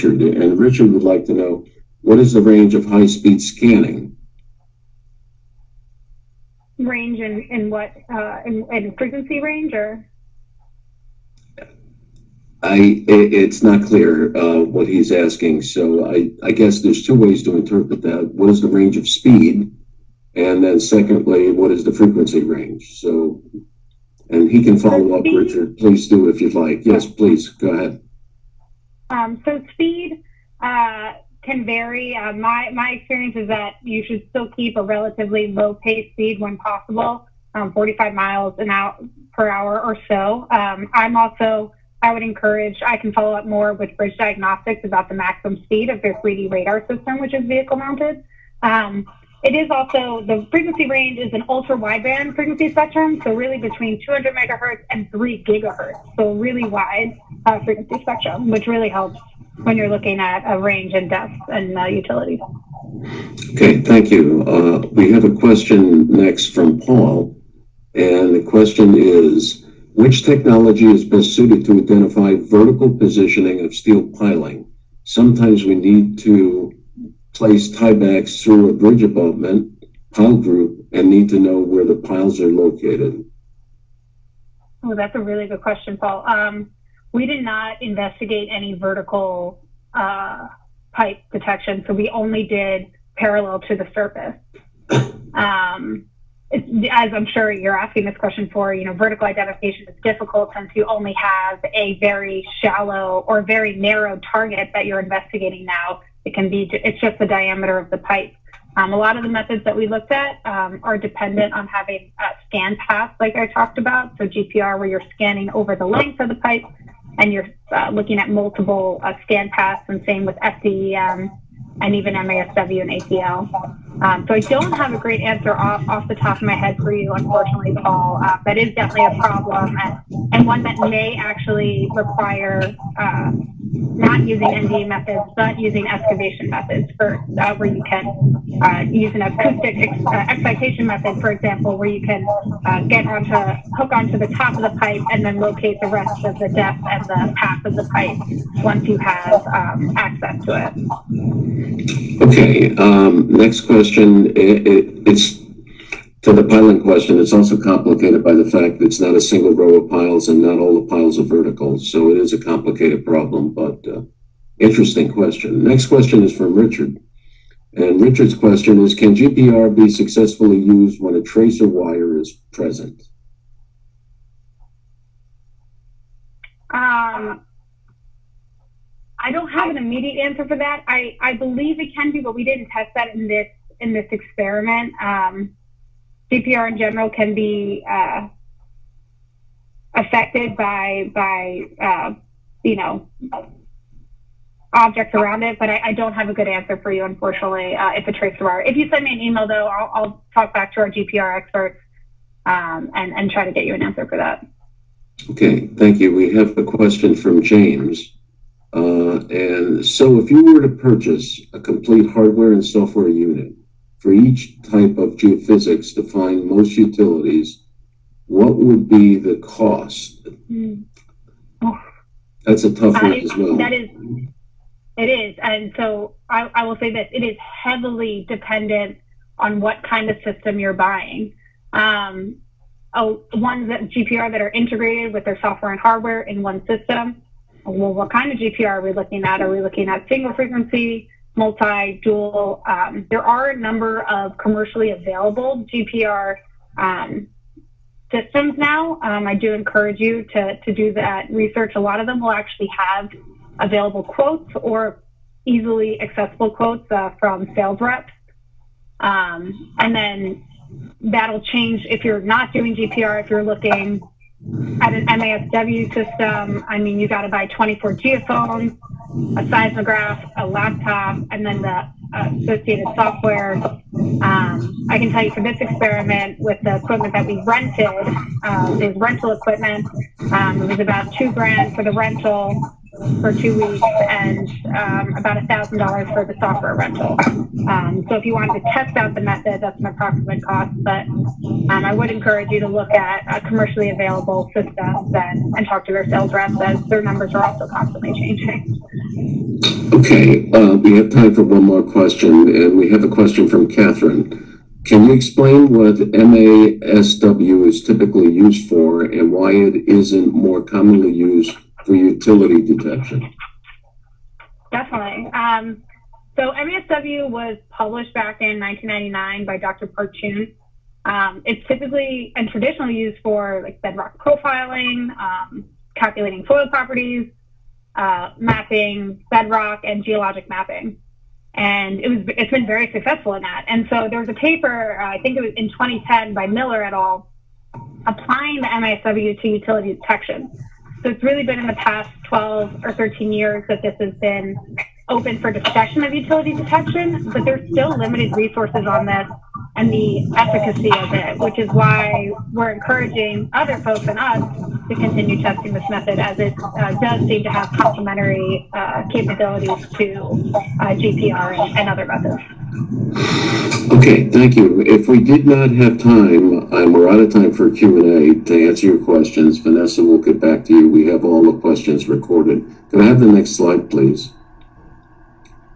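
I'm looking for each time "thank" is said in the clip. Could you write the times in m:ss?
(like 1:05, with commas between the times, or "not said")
1:03, 3:25, 6:04.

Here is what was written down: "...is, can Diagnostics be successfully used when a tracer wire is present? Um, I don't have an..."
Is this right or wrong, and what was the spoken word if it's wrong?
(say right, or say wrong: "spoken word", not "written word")
wrong: "GPR", not "Diagnostics".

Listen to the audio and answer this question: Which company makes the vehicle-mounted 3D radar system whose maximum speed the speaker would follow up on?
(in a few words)
Bridge Diagnostics.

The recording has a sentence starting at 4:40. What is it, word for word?
Um, it was about two grand for the rental for two weeks and um, about $1,000 for the software rental.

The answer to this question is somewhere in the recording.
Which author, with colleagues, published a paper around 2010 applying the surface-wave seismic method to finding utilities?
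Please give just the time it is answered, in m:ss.
5:36.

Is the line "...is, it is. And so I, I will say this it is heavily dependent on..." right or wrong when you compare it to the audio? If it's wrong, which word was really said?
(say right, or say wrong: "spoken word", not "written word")
right.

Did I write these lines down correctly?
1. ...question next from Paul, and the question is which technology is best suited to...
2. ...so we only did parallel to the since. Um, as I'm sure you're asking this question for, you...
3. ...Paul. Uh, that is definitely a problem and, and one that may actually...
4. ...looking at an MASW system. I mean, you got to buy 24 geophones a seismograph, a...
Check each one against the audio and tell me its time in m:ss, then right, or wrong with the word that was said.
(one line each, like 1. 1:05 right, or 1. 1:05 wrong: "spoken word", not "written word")
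1. 1:05 right
2. 1:31 wrong: "surface", not "since"
3. 2:07 right
4. 4:23 right.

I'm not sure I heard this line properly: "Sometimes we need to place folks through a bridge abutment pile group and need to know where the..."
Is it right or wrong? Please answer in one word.
wrong.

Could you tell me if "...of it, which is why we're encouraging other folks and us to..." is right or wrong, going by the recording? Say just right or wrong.
right.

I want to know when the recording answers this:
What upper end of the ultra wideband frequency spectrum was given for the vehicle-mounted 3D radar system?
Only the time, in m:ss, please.
0:55.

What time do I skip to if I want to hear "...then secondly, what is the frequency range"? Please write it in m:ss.
0:20.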